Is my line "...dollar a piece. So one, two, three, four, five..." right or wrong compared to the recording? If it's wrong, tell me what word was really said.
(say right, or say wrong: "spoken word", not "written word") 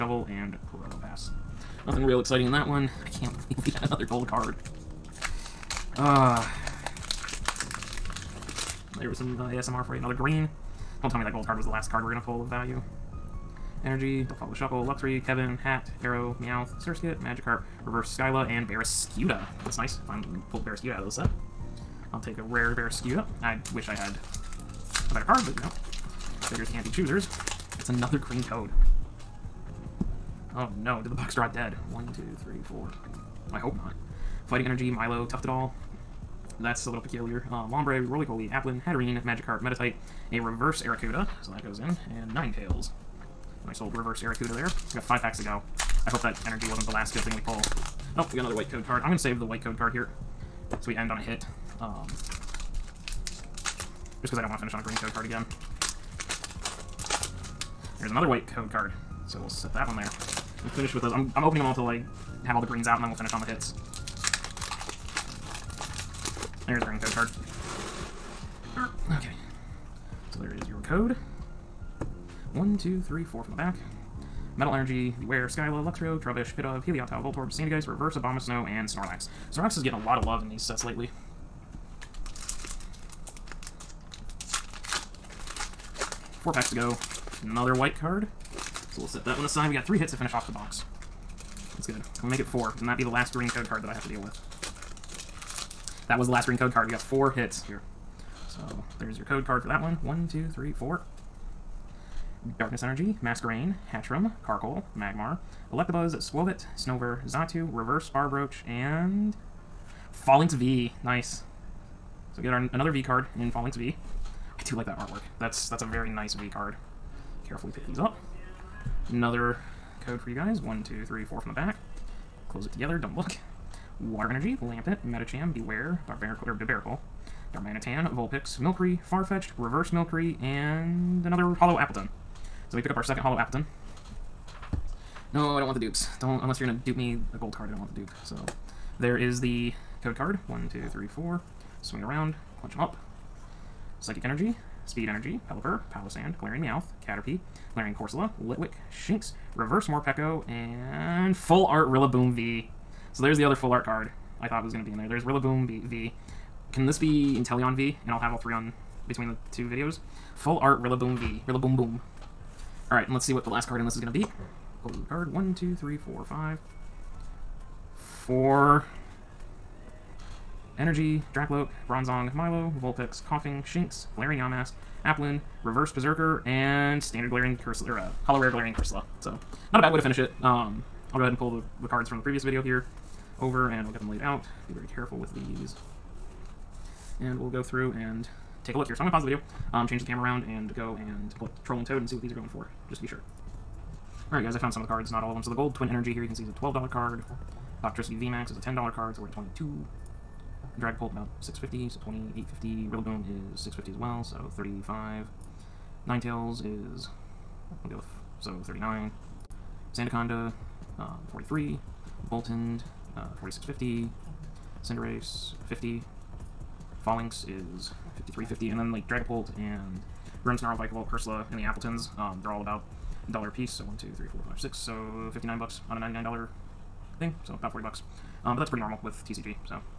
right.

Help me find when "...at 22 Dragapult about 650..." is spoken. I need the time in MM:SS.
03:19.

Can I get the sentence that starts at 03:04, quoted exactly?
Be very careful with these and we'll go through and take a look here.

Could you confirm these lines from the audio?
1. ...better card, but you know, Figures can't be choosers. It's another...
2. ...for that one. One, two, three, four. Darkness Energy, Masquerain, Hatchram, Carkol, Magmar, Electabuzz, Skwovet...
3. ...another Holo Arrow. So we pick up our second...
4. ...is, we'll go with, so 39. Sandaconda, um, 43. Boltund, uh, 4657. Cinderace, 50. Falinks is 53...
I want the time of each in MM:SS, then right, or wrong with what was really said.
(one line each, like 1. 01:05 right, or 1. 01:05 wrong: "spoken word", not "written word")
1. 00:25 right
2. 01:39 right
3. 02:11 wrong: "Appletun", not "Arrow"
4. 03:26 wrong: "4650", not "4657".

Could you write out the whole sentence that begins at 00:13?
Energy, Don't Follow the Shuckle, Luxury, Kevin, Hat, Arrow, Meowth, Surskit, Magikarp, Reverse Skyla, and Barraskewda.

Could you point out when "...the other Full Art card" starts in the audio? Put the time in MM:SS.
02:33.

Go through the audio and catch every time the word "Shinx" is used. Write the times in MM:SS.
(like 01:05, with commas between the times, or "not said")
02:28, 02:53.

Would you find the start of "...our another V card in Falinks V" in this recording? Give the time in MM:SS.
01:52.